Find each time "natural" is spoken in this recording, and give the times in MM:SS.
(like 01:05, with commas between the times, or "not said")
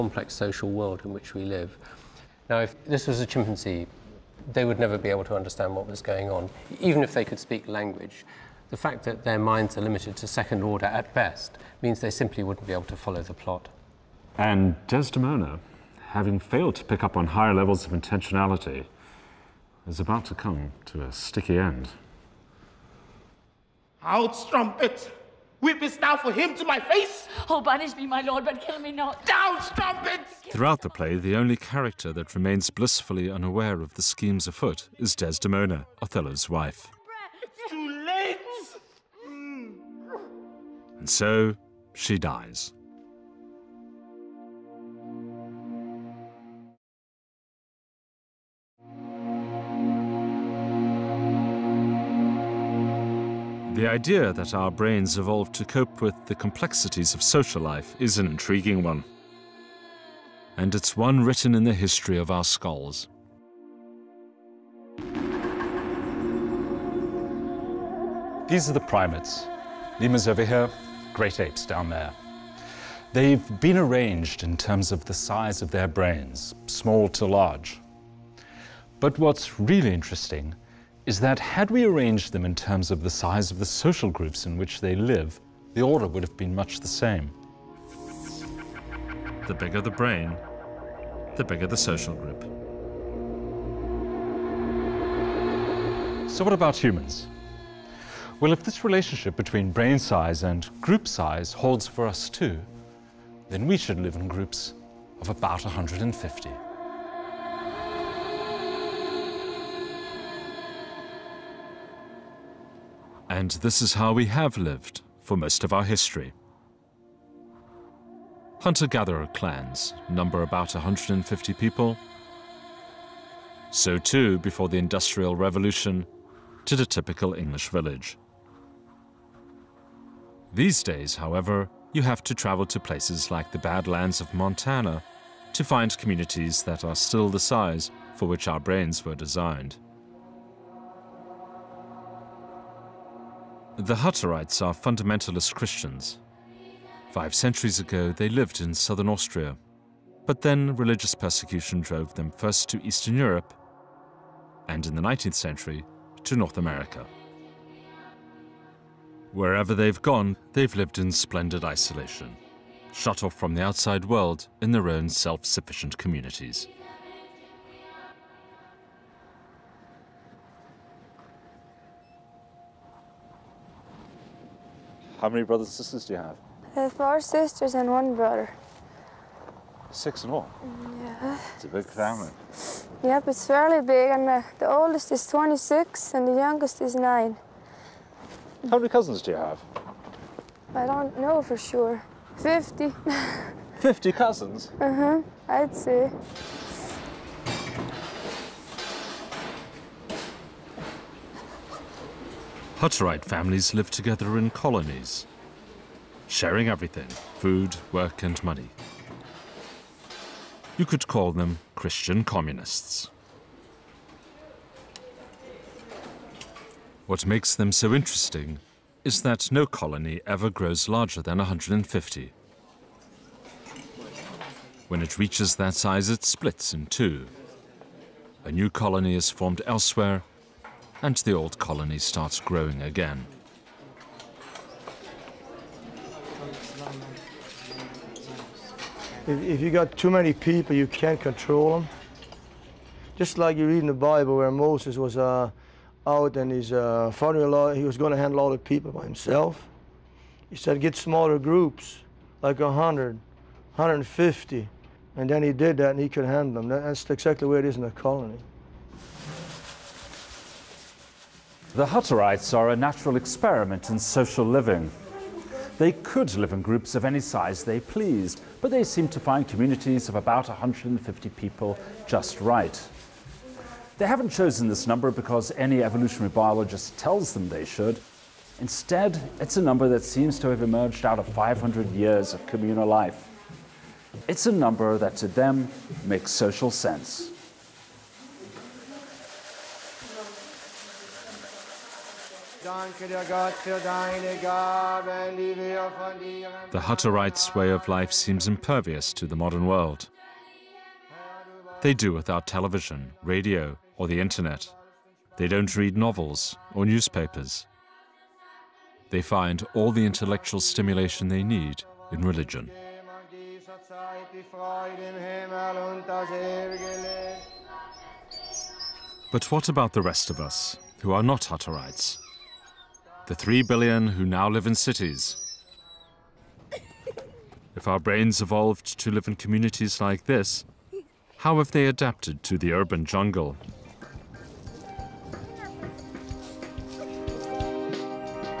04:22.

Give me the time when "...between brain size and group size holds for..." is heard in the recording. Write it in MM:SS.
01:39.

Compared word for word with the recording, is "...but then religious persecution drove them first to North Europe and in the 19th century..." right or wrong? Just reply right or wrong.
wrong.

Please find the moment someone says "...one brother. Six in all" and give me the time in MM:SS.
02:57.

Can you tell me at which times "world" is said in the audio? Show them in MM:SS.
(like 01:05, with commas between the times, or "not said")
00:00, 02:44, 04:59.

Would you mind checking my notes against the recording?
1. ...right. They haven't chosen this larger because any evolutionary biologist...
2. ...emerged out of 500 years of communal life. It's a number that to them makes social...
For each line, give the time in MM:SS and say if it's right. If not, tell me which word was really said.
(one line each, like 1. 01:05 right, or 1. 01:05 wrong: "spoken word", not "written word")
1. 04:32 wrong: "number", not "larger"
2. 04:40 right.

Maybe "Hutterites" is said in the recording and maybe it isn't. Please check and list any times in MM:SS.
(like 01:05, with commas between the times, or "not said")
02:23, 03:22, 04:21, 04:56, 05:21.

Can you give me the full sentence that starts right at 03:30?
You could call them Christian communists.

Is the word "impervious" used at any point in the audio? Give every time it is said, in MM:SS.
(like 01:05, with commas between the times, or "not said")
04:58.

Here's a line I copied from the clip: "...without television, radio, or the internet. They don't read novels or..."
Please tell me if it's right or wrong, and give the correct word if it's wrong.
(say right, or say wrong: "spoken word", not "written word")
right.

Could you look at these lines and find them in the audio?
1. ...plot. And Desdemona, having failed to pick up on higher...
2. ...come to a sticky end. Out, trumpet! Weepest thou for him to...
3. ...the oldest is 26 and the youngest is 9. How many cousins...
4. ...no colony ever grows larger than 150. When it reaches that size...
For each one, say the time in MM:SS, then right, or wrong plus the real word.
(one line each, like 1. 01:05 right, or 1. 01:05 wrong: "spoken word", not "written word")
1. 00:13 right
2. 00:20 right
3. 03:04 right
4. 03:39 right.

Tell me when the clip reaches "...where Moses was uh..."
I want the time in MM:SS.
04:04.